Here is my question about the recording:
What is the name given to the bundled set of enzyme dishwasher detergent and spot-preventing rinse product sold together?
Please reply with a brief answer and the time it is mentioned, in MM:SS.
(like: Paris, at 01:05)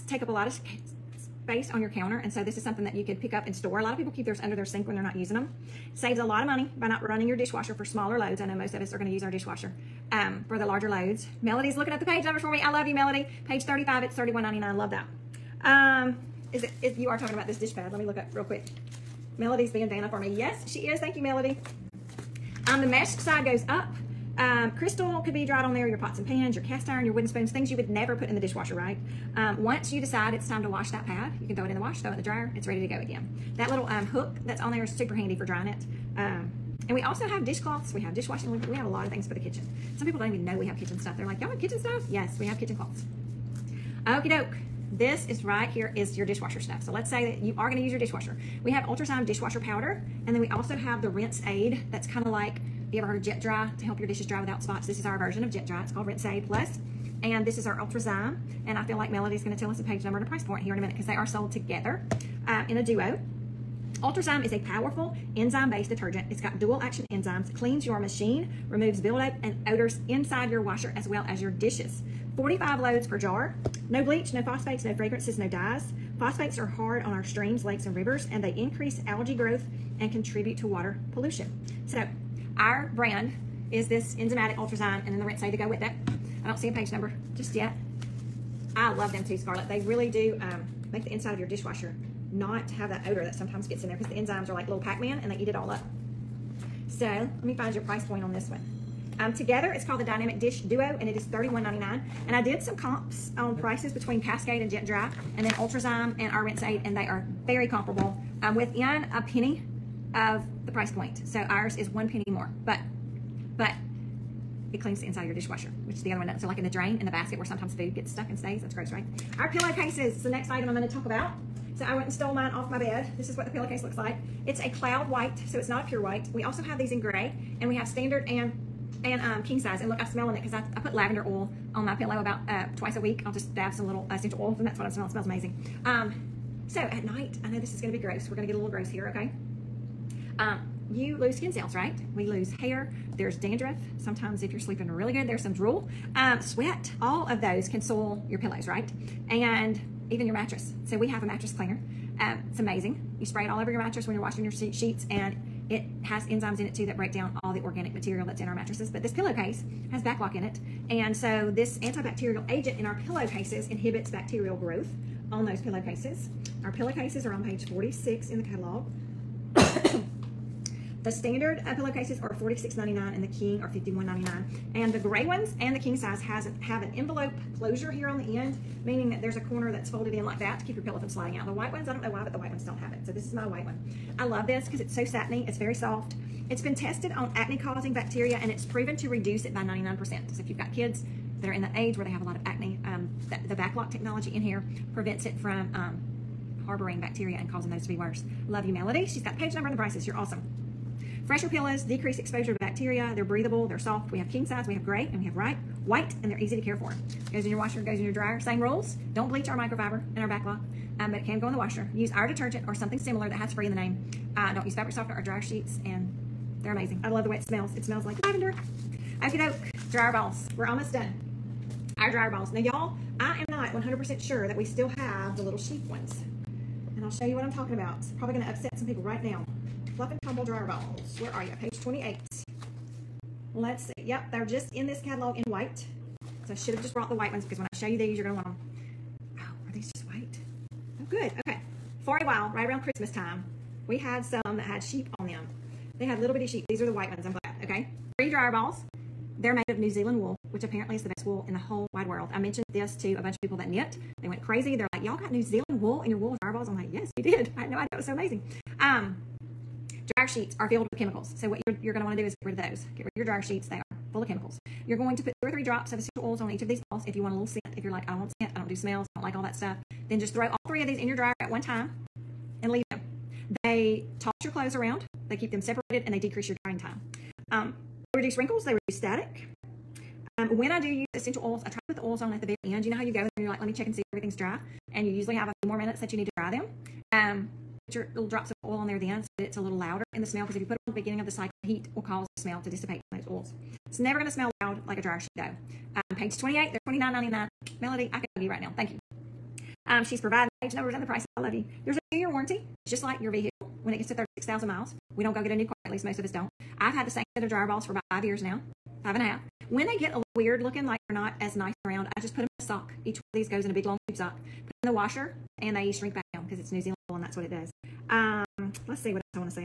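Dynamic Dish Duo, at 01:40.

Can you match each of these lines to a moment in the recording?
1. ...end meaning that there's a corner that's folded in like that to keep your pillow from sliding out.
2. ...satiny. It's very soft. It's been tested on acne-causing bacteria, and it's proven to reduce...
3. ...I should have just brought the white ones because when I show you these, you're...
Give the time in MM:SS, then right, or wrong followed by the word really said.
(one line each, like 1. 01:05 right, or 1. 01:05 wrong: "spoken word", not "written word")
1. 02:58 right
2. 03:05 right
3. 03:56 right.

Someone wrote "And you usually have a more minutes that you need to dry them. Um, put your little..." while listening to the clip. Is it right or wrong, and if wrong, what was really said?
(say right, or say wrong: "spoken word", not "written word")
right.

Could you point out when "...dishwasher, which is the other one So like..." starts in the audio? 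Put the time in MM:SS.
01:55.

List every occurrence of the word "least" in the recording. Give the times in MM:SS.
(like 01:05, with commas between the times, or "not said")
05:05.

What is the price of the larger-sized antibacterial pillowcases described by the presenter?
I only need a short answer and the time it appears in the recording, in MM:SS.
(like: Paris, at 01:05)
$51.99, at 02:53.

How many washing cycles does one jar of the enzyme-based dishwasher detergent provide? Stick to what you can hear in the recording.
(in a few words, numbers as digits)
45.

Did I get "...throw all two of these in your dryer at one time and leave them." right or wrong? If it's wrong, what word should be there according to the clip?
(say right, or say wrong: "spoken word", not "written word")
wrong: "three", not "two".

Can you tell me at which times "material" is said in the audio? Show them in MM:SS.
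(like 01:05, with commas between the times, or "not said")
02:37.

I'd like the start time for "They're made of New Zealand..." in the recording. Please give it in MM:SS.
04:09.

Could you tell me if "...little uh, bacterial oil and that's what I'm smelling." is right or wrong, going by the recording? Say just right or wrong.
wrong.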